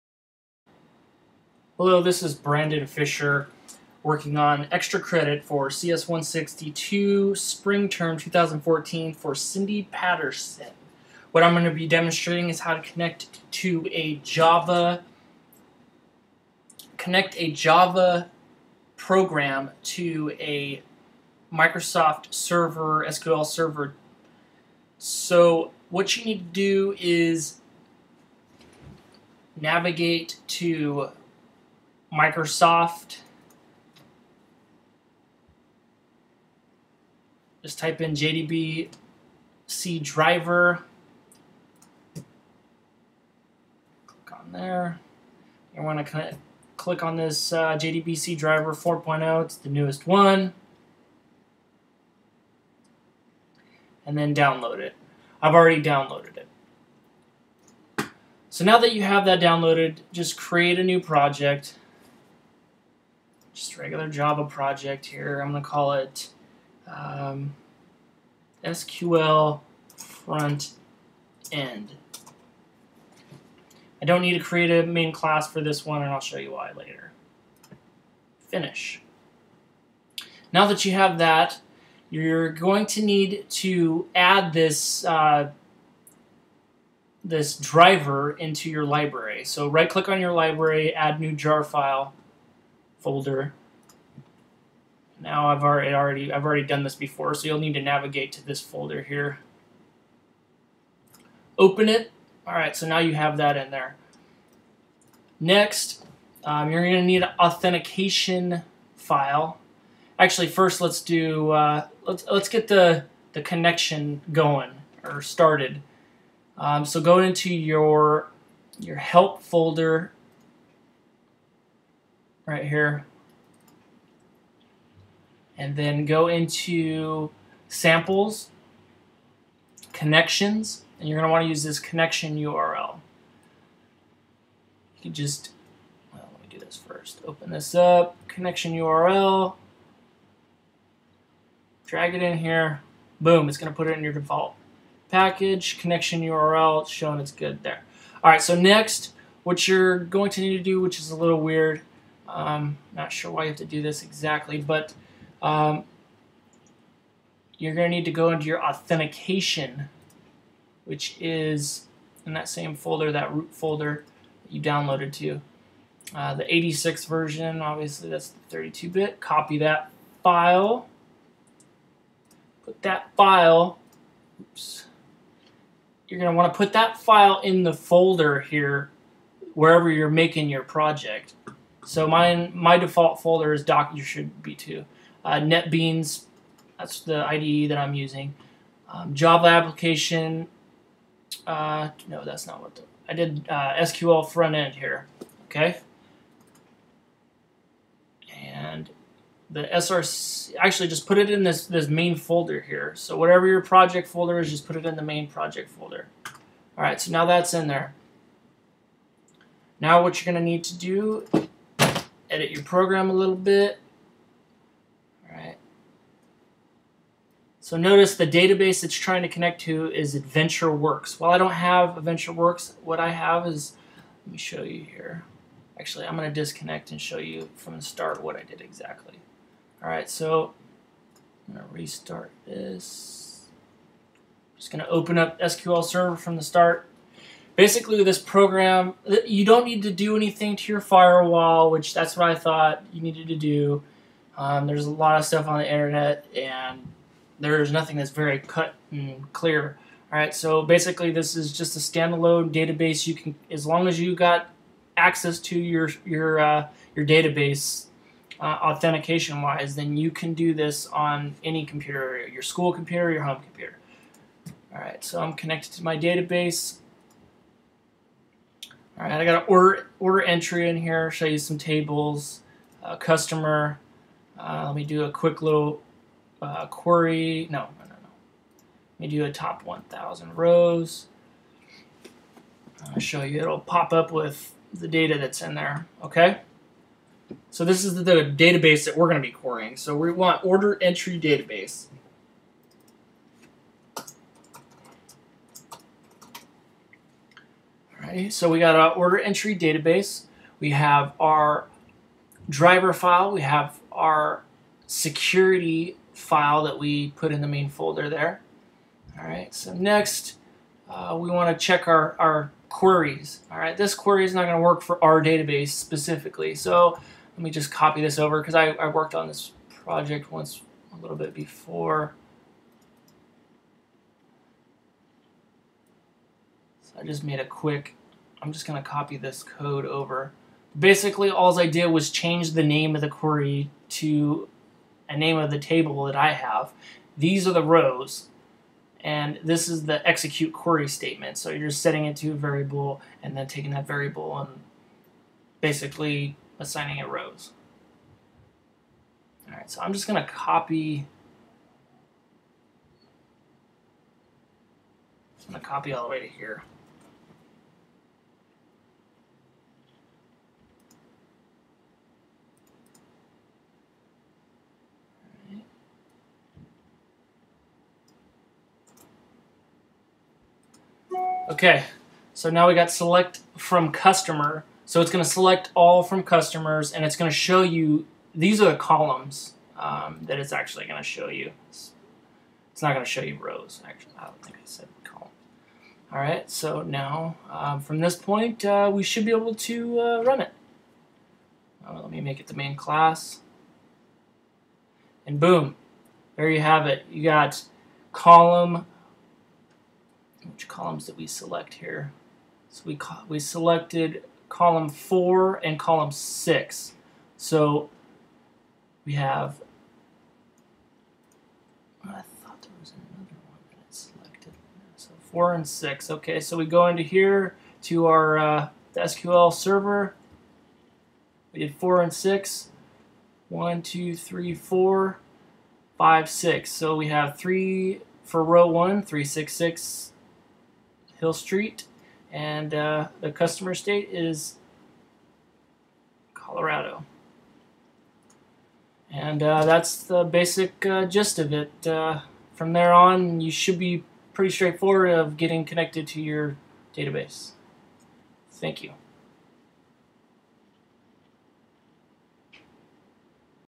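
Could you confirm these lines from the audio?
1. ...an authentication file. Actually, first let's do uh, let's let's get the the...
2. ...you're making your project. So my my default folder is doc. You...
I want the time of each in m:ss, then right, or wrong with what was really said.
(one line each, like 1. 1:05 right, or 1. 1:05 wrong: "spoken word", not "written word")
1. 1:47 right
2. 2:59 right.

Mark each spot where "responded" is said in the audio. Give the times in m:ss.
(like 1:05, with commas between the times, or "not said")
not said.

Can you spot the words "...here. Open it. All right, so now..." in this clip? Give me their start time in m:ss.
1:39.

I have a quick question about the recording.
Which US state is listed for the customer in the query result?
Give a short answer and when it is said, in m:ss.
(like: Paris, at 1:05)
Colorado, at 7:16.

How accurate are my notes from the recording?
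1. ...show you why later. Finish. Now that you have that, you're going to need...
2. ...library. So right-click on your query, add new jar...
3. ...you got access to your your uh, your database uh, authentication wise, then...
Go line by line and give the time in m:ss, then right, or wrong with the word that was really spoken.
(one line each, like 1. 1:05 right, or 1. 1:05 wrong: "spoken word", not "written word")
1. 1:16 right
2. 1:28 wrong: "library", not "query"
3. 4:13 right.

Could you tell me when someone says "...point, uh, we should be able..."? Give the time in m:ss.
6:28.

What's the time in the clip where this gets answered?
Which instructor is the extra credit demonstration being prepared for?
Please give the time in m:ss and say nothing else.
0:09.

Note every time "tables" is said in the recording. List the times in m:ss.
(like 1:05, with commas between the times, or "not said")
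4:31, 5:35.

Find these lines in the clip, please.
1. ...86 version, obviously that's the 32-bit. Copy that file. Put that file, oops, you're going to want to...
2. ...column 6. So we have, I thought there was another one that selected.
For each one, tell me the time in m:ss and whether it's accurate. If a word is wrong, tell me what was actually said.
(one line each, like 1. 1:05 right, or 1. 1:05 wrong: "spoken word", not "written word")
1. 2:46 right
2. 6:45 right.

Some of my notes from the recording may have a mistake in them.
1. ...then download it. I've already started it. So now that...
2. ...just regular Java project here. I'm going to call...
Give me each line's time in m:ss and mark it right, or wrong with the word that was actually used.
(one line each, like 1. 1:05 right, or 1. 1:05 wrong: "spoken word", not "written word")
1. 0:54 wrong: "downloaded", not "started"
2. 1:03 right.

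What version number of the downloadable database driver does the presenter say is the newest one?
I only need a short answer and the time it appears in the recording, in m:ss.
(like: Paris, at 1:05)
4.0, at 0:48.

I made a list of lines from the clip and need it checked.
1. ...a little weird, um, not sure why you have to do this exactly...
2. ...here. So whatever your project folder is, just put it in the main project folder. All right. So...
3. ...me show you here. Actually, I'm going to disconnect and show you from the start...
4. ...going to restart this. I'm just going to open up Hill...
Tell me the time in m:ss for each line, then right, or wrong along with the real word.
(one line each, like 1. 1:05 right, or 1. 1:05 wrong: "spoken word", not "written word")
1. 2:31 right
2. 3:22 right
3. 3:44 right
4. 3:51 wrong: "SQL", not "Hill".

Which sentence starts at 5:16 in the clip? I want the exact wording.
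So let me just copy this over because I, I worked on this project once a little bit before.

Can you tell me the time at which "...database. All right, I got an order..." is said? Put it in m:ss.
4:25.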